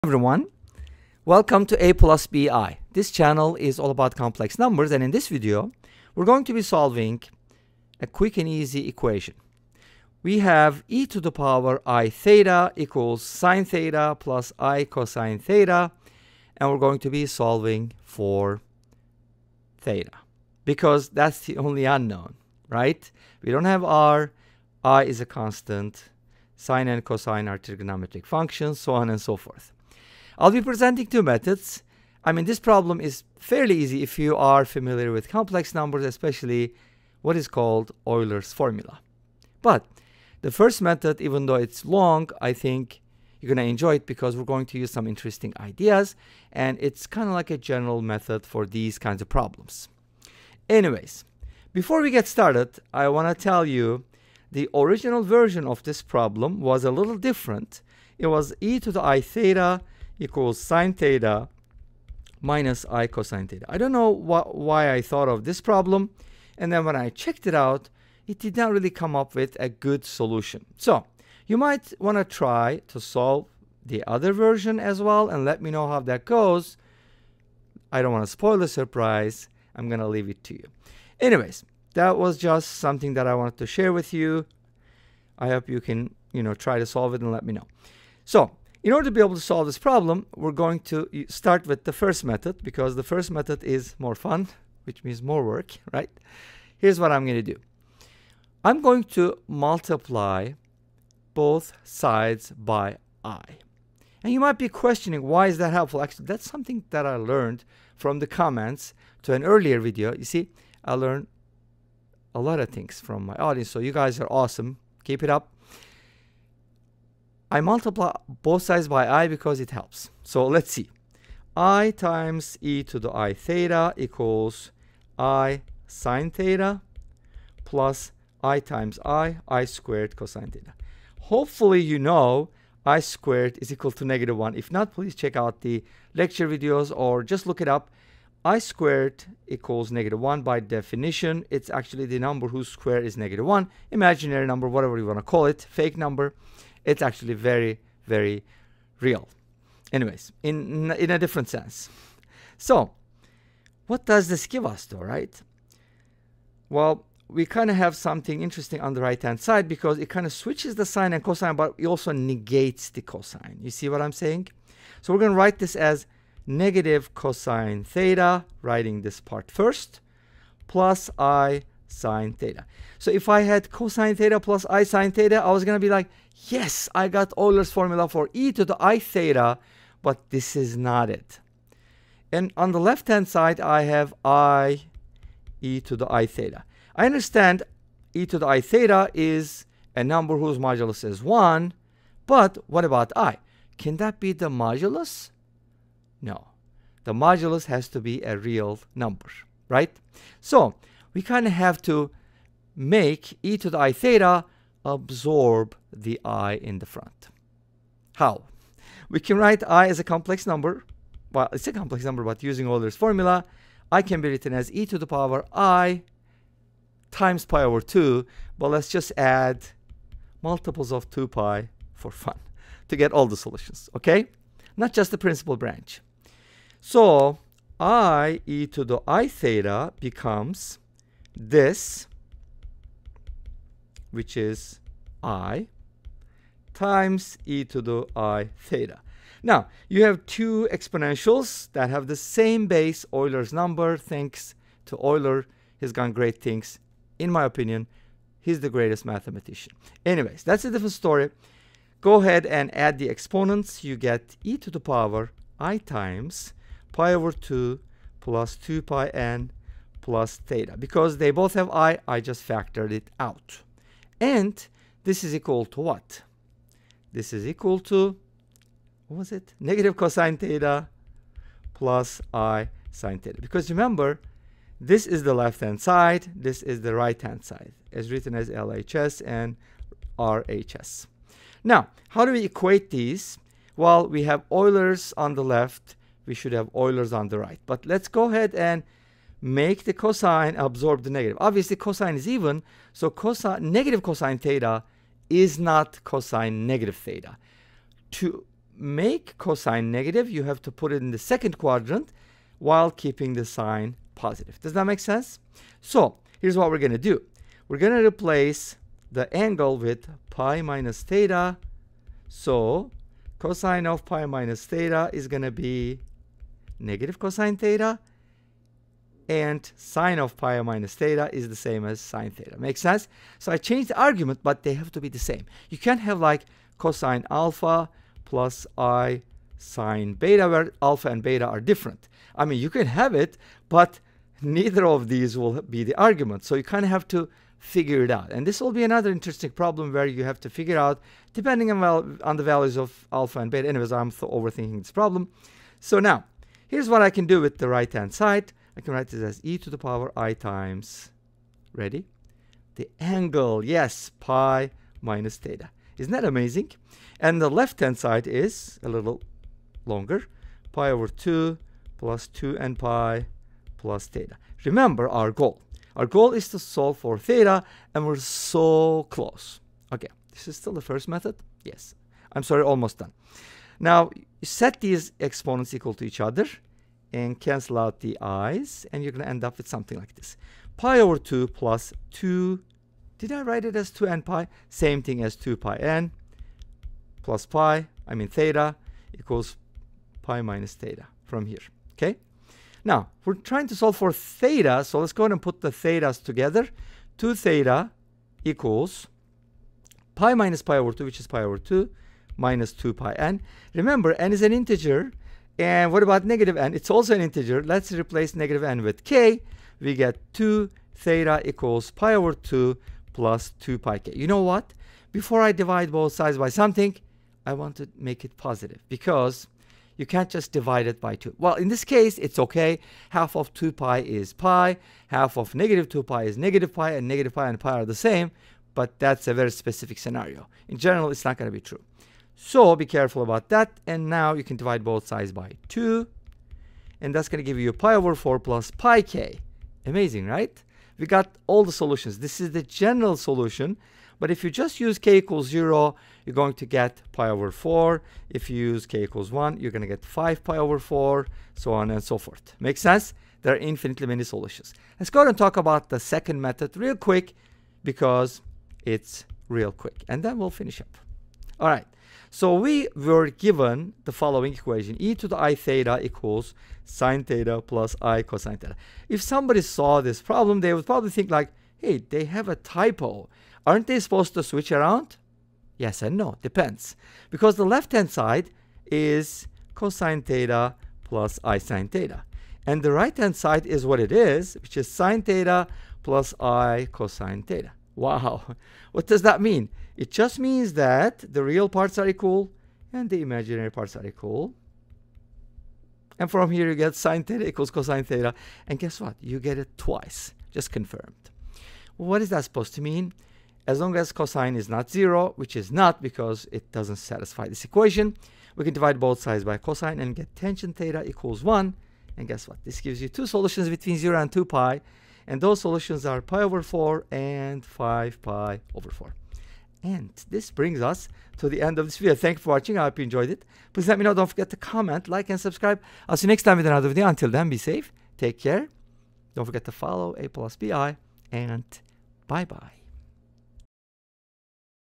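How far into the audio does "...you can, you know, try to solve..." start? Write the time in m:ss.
1:25.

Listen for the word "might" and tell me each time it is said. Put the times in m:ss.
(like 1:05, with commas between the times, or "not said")
1:11, 1:44.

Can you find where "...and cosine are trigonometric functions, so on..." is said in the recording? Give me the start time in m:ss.
0:26.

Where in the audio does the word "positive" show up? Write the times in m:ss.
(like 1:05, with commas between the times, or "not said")
5:04, 6:58.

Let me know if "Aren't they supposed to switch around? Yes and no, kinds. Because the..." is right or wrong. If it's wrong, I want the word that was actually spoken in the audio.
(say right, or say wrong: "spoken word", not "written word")
wrong: "depends", not "kinds".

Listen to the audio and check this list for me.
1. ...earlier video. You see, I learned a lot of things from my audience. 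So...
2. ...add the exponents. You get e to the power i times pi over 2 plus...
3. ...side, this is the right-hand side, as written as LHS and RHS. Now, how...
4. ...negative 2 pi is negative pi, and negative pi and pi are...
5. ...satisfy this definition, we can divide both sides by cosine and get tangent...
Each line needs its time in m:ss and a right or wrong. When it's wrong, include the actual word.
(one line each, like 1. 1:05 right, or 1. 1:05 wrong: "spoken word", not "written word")
1. 1:49 right
2. 4:12 right
3. 4:35 right
4. 7:05 right
5. 8:26 wrong: "equation", not "definition".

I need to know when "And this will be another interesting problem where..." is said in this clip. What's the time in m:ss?
5:38.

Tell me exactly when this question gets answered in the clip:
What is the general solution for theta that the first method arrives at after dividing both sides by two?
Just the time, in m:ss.
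7:17.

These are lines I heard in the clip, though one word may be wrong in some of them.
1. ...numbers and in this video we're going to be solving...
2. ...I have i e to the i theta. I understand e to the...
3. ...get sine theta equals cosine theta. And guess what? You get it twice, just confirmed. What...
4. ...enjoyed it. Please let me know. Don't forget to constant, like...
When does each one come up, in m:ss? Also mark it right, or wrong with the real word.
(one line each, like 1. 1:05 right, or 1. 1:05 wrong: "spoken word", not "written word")
1. 0:04 right
2. 3:03 right
3. 8:16 right
4. 8:43 wrong: "comment", not "constant".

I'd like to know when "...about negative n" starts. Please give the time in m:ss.
6:46.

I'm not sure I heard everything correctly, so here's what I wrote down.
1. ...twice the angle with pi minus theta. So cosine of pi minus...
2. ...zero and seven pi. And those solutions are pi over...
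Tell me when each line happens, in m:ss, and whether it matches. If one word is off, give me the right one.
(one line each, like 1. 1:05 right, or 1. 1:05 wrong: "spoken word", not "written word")
1. 5:08 wrong: "replace", not "twice"
2. 8:33 wrong: "two", not "seven".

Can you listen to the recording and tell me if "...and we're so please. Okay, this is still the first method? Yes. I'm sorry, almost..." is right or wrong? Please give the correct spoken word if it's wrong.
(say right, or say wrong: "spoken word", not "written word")
wrong: "close", not "please".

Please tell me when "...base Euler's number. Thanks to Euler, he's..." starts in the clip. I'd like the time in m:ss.
4:02.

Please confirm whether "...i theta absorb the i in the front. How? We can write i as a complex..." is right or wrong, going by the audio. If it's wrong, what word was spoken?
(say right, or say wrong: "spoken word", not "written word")
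right.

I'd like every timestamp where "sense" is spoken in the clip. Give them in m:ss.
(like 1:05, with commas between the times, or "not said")
2:31, 5:04, 5:22, 7:32.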